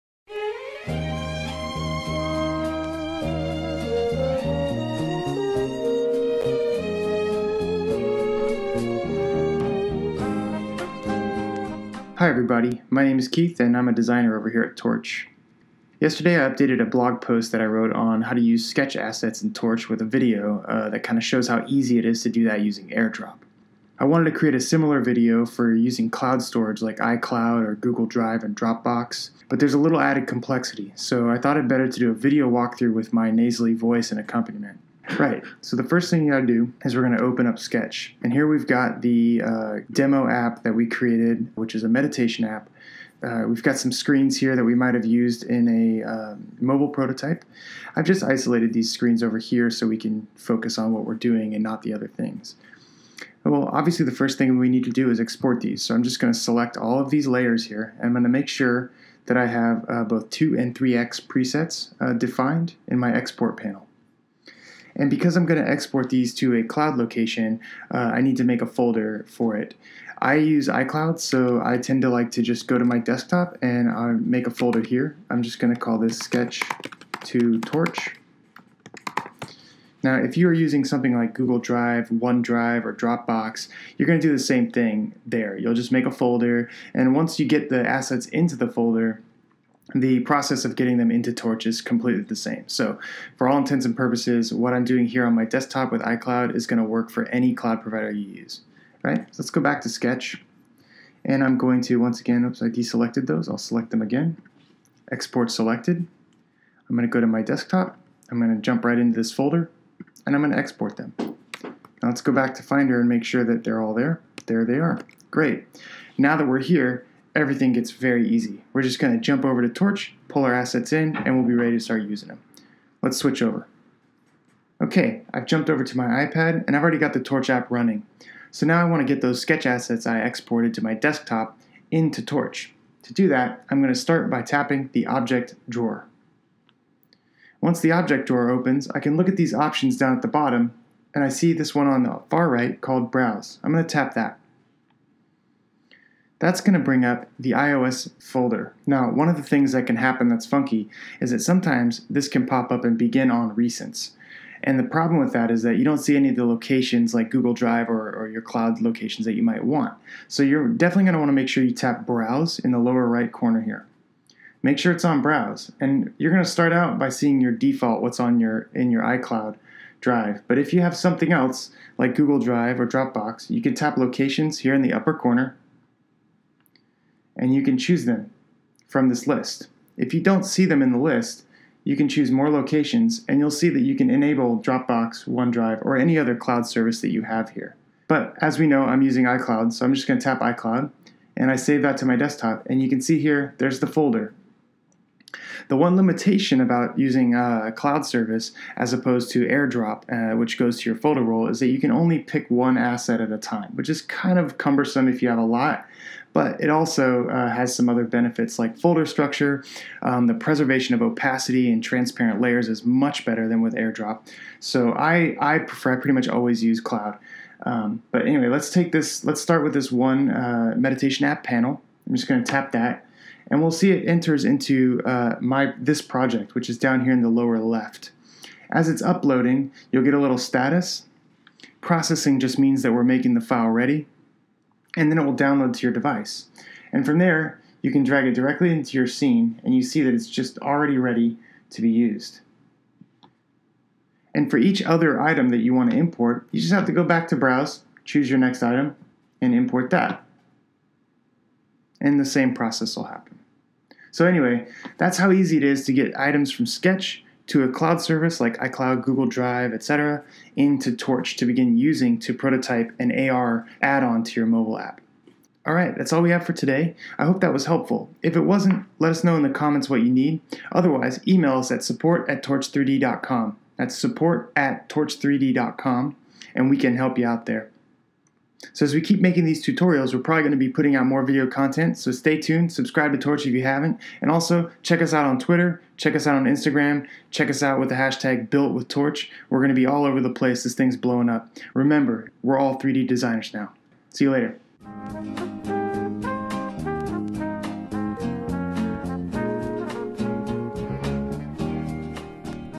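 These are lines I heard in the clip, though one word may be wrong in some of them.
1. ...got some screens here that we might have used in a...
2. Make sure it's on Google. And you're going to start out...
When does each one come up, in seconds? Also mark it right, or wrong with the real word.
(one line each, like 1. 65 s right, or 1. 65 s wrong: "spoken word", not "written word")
1. 43 s right
2. 164 s wrong: "Browse", not "Google".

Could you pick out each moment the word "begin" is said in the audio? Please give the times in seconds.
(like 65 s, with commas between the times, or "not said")
152 s, 261 s.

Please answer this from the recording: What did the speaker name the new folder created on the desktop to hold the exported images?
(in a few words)
sketch to torch.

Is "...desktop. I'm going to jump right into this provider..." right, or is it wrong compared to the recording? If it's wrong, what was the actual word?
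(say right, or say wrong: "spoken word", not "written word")
wrong: "folder", not "provider".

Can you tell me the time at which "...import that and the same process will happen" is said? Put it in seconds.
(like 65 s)
249 s.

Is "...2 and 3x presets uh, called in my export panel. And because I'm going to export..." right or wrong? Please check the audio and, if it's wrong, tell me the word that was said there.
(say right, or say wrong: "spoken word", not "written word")
wrong: "defined", not "called".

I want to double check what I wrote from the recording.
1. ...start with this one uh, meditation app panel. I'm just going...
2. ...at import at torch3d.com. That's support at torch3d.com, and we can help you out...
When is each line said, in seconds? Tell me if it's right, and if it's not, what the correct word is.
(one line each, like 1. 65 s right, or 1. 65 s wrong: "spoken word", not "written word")
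1. 219 s right
2. 271 s wrong: "support", not "import".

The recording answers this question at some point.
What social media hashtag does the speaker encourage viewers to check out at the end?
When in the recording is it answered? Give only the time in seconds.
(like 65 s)
288 s.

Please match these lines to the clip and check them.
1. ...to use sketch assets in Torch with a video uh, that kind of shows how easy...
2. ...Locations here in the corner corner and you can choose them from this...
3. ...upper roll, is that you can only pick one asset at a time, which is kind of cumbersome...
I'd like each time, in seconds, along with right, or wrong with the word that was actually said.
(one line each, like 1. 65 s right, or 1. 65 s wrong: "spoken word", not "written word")
1. 18 s right
2. 173 s wrong: "upper", not "corner"
3. 200 s wrong: "folder", not "upper".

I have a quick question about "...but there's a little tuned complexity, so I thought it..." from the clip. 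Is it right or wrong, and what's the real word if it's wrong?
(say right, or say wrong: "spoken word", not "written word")
wrong: "added", not "tuned".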